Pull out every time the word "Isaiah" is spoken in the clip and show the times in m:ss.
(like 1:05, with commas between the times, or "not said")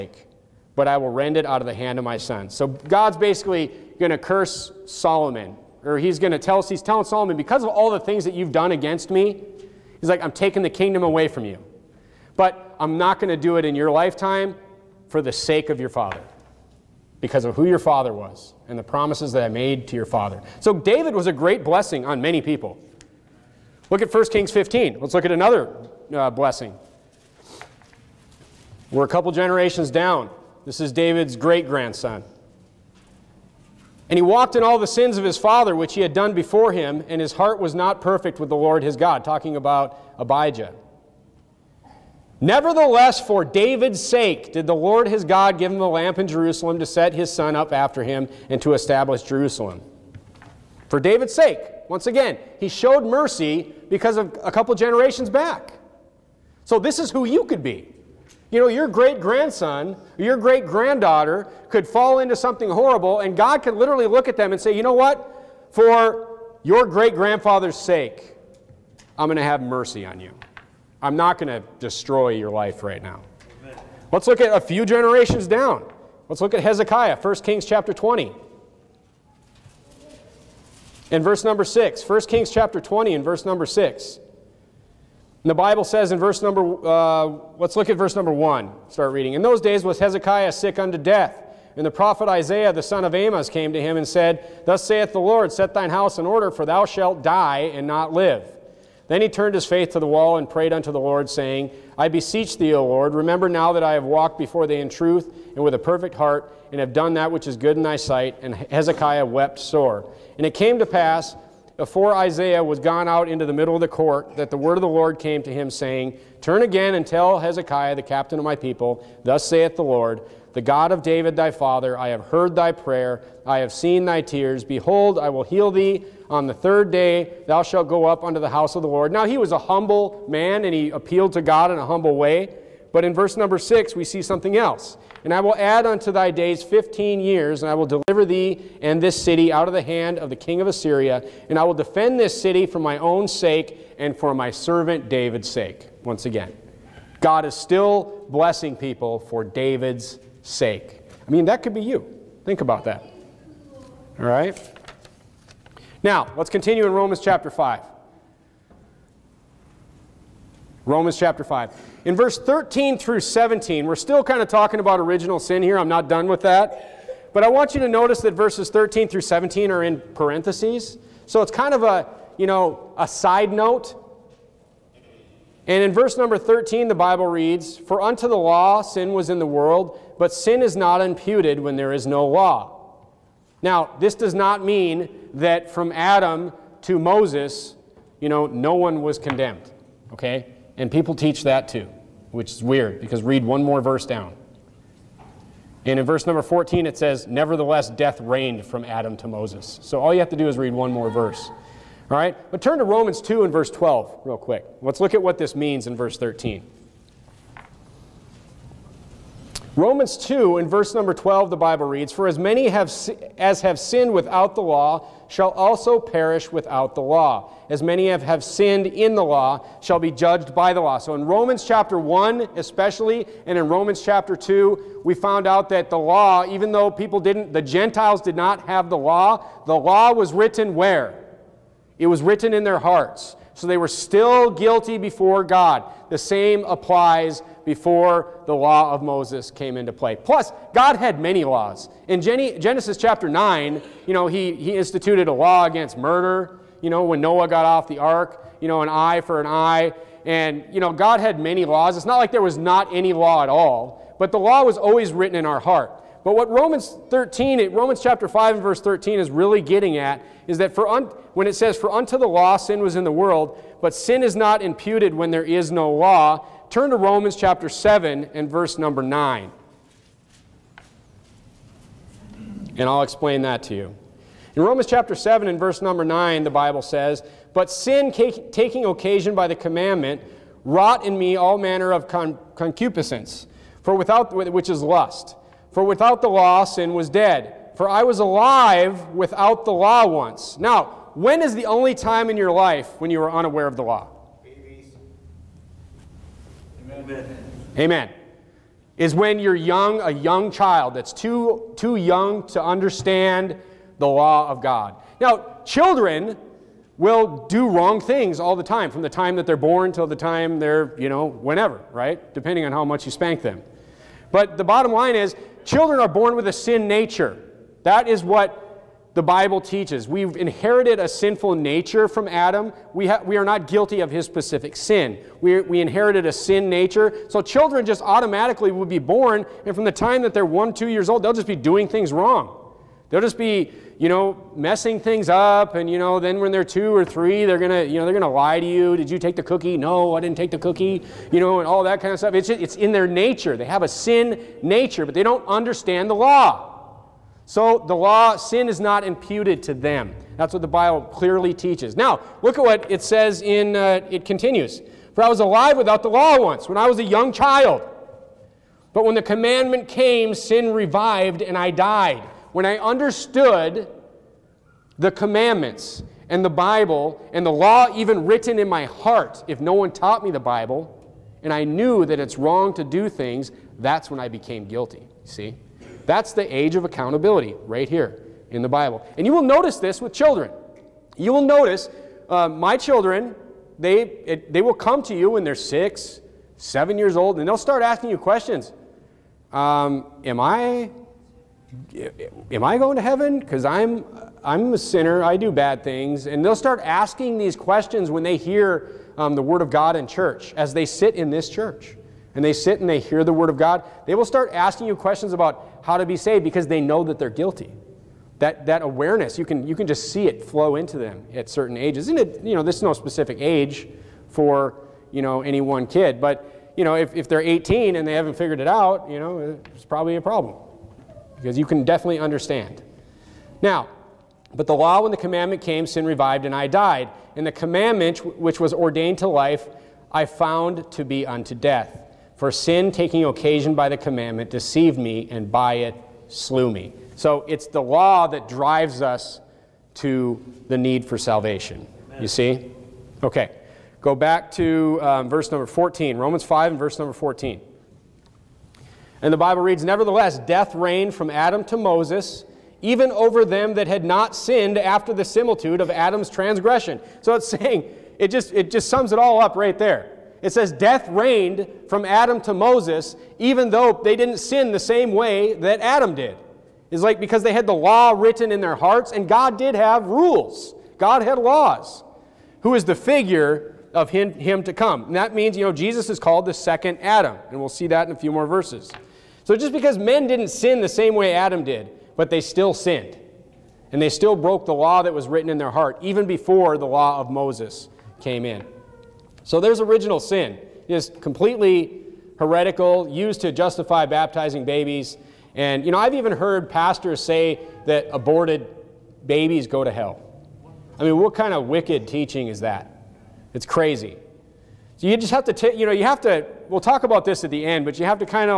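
1:32, 1:52.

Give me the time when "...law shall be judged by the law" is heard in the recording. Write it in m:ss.
3:39.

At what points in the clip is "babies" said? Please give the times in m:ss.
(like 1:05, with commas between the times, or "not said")
8:14, 8:19.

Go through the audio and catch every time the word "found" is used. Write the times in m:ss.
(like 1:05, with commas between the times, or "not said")
3:45, 7:10.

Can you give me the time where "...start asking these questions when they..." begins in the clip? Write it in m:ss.
6:36.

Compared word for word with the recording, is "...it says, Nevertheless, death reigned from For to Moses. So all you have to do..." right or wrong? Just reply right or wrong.
wrong.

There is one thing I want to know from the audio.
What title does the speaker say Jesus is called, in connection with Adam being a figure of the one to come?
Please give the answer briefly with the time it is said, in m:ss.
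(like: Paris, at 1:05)
the second Adam, at 7:56.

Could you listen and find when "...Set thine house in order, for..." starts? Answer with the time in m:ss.
1:35.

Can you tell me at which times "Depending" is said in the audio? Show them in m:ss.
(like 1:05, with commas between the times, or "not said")
5:12.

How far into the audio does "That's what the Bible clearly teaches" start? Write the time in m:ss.
5:50.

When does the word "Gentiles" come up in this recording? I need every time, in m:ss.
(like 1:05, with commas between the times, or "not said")
3:47.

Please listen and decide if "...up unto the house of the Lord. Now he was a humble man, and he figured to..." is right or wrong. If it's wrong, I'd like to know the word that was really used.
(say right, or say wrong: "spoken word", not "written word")
wrong: "appealed", not "figured".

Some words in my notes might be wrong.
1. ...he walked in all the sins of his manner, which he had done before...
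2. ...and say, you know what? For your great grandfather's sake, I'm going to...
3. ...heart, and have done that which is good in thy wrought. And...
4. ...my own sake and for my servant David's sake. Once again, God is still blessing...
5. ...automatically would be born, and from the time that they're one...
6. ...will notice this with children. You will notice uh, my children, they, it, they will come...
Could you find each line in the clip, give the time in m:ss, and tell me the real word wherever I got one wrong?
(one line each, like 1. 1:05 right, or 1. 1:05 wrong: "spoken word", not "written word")
1. 0:34 wrong: "father", not "manner"
2. 1:04 right
3. 1:46 wrong: "sight", not "wrought"
4. 2:22 right
5. 5:28 right
6. 6:19 right.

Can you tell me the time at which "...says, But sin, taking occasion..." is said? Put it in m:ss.
4:36.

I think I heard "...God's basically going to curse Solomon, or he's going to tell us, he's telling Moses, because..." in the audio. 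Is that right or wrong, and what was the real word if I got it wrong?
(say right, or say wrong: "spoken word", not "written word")
wrong: "Solomon", not "Moses".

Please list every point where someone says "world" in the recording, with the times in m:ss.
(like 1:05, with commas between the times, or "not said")
2:59, 4:23.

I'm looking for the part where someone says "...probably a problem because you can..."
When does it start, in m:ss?
6:59.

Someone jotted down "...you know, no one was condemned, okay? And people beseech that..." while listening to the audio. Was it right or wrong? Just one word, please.
wrong.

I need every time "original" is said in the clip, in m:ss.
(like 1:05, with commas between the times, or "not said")
2:44, 8:09.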